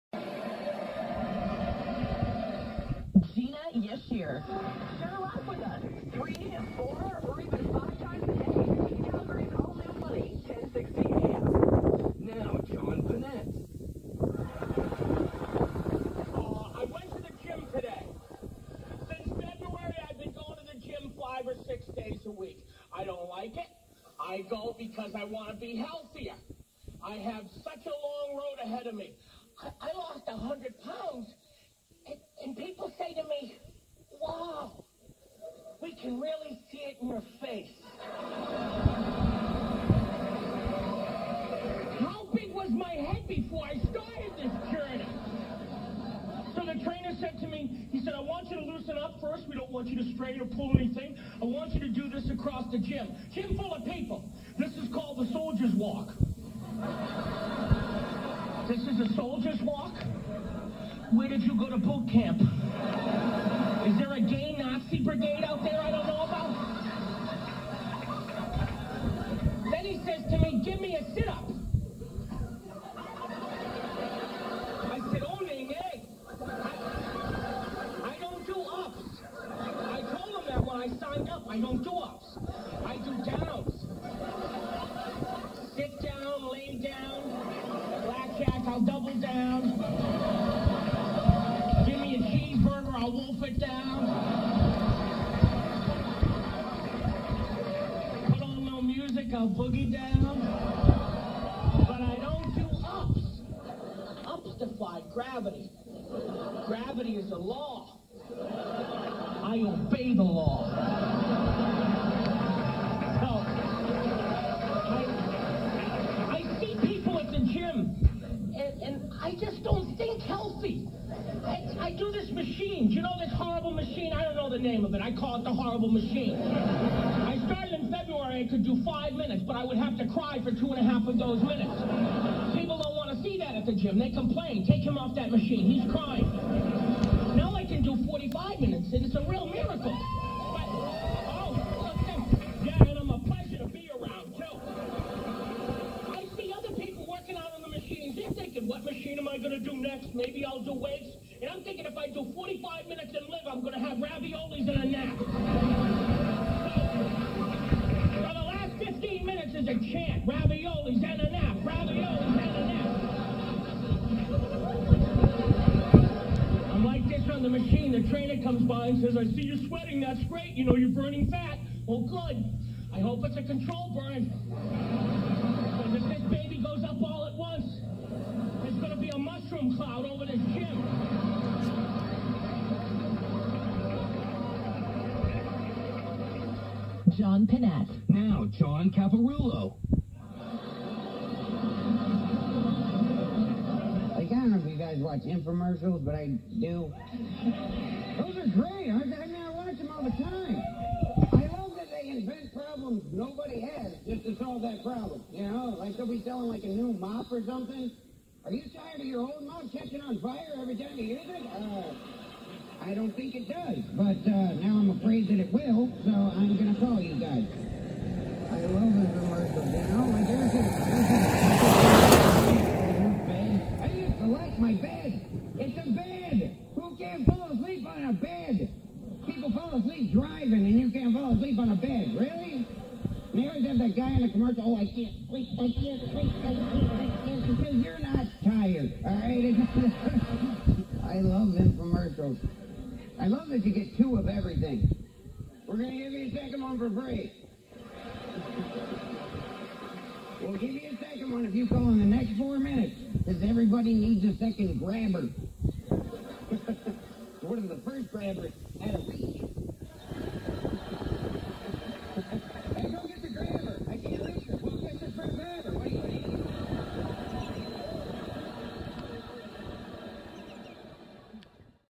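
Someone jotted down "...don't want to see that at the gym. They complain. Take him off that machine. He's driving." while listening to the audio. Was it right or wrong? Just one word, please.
wrong.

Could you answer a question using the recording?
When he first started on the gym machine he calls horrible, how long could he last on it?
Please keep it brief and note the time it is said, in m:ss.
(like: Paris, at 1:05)
5 minutes, at 2:08.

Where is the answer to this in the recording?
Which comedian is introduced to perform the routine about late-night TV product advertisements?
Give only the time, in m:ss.
3:08.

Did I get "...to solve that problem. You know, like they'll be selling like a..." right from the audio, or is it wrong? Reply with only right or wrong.
right.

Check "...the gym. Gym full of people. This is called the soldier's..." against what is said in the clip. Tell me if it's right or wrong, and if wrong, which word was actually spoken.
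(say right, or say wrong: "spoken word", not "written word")
right.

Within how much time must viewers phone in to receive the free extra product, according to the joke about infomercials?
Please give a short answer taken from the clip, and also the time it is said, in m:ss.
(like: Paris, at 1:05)
4 minutes, at 4:12.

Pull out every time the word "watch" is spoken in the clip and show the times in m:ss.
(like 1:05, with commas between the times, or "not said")
3:14, 3:19.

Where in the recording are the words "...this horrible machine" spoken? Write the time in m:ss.
2:03.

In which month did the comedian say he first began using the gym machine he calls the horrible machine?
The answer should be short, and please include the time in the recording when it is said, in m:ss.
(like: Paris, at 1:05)
February, at 2:07.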